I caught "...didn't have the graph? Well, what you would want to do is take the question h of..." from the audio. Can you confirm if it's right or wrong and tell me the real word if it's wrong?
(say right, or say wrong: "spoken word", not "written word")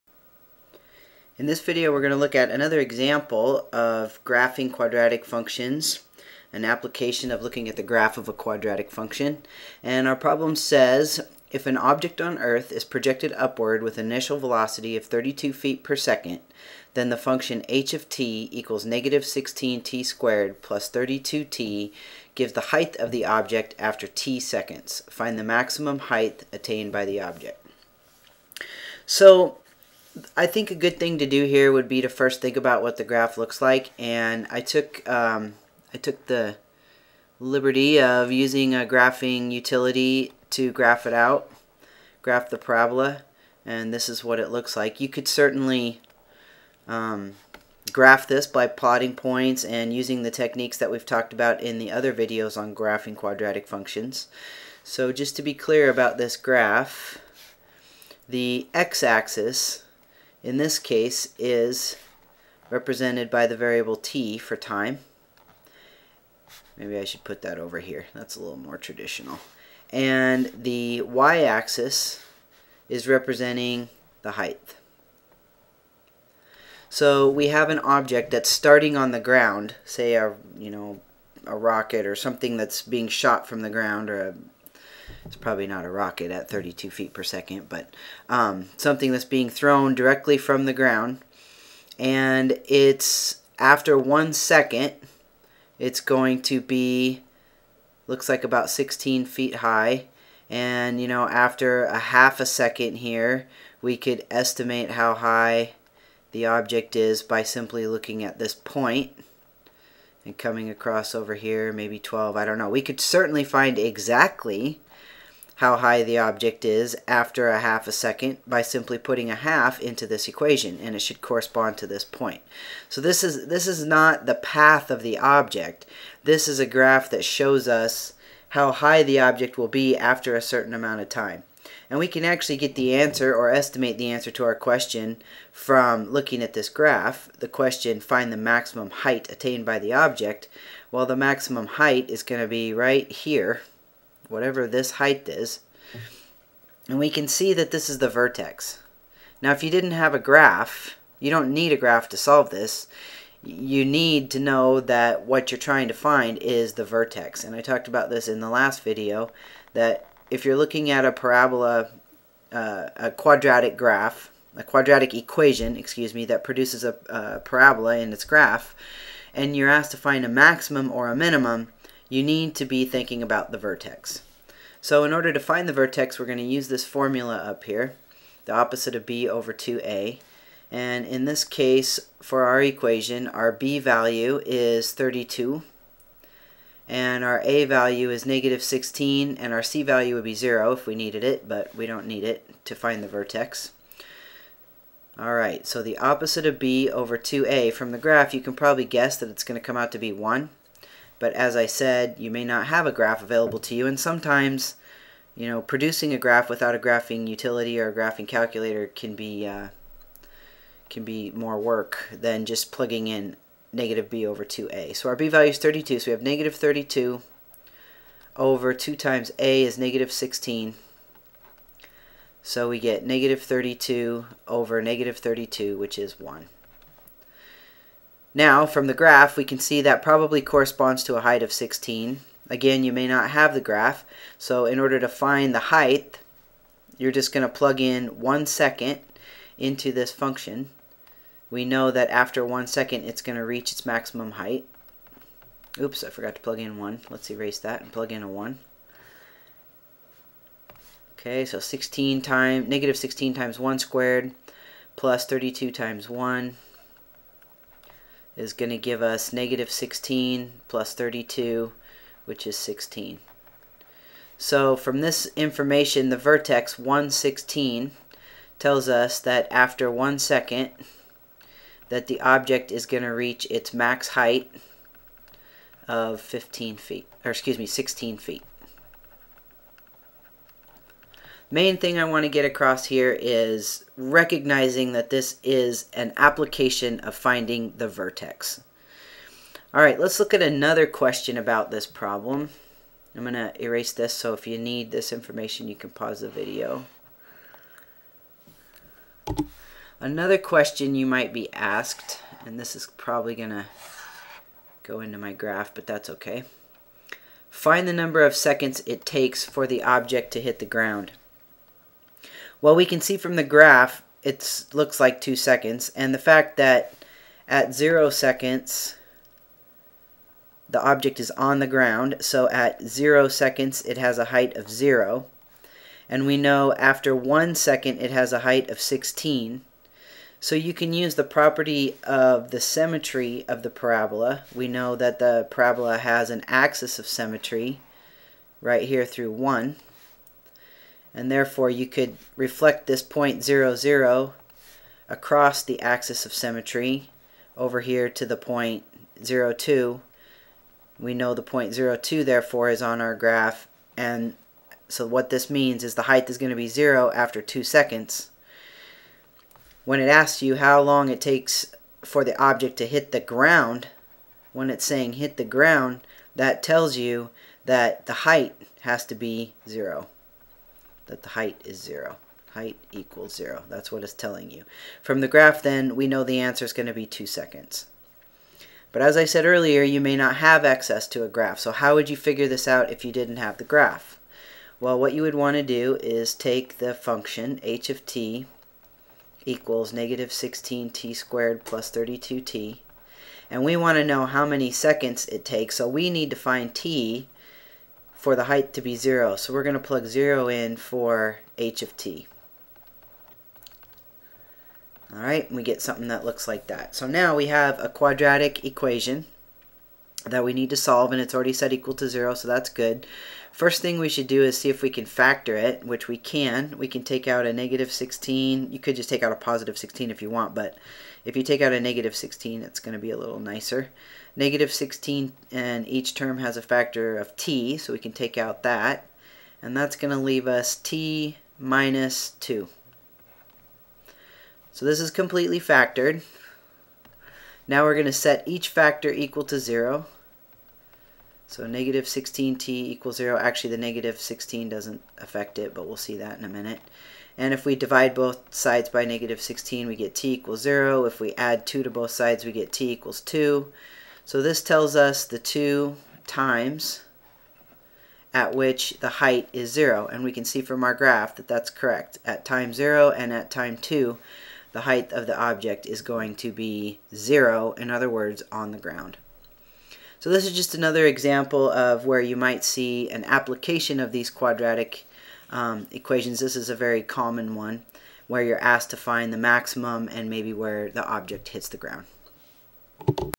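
wrong: "function", not "question".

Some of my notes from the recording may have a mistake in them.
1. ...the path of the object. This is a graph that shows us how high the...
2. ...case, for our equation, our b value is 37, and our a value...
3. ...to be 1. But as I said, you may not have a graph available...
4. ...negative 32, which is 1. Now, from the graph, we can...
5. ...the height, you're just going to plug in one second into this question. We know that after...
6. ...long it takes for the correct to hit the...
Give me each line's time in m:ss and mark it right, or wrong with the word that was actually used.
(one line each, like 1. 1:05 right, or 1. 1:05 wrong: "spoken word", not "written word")
1. 2:04 right
2. 3:01 wrong: "32", not "37"
3. 3:19 right
4. 3:44 right
5. 3:55 wrong: "function", not "question"
6. 6:00 wrong: "object", not "correct".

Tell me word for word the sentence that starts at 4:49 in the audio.
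All right, let's look at another question about this problem.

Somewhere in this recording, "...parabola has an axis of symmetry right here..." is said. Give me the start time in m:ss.
5:35.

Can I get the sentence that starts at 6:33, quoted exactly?
And we want to know how many seconds it takes.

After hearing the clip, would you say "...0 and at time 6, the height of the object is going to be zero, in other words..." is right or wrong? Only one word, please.
wrong.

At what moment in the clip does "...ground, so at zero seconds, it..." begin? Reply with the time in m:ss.
5:21.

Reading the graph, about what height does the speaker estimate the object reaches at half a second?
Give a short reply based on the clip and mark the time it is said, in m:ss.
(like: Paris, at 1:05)
12, at 1:51.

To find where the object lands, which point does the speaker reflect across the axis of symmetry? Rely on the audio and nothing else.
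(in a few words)
zero zero.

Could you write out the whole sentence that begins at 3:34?
So our b value is 32, so we have negative 32 over 2 times a is negative 16.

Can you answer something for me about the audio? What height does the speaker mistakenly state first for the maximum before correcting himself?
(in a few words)
15 feet.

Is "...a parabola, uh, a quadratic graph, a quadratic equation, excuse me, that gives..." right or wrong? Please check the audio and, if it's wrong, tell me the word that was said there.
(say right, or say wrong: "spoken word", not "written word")
wrong: "produces", not "gives".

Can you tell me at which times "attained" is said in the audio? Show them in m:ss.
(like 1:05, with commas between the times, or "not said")
0:26, 2:19.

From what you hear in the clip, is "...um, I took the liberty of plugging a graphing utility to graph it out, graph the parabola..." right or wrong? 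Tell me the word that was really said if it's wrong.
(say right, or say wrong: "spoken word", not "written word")
wrong: "using", not "plugging".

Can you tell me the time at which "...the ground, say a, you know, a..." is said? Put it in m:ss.
1:19.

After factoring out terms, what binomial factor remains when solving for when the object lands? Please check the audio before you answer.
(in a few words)
t minus 2.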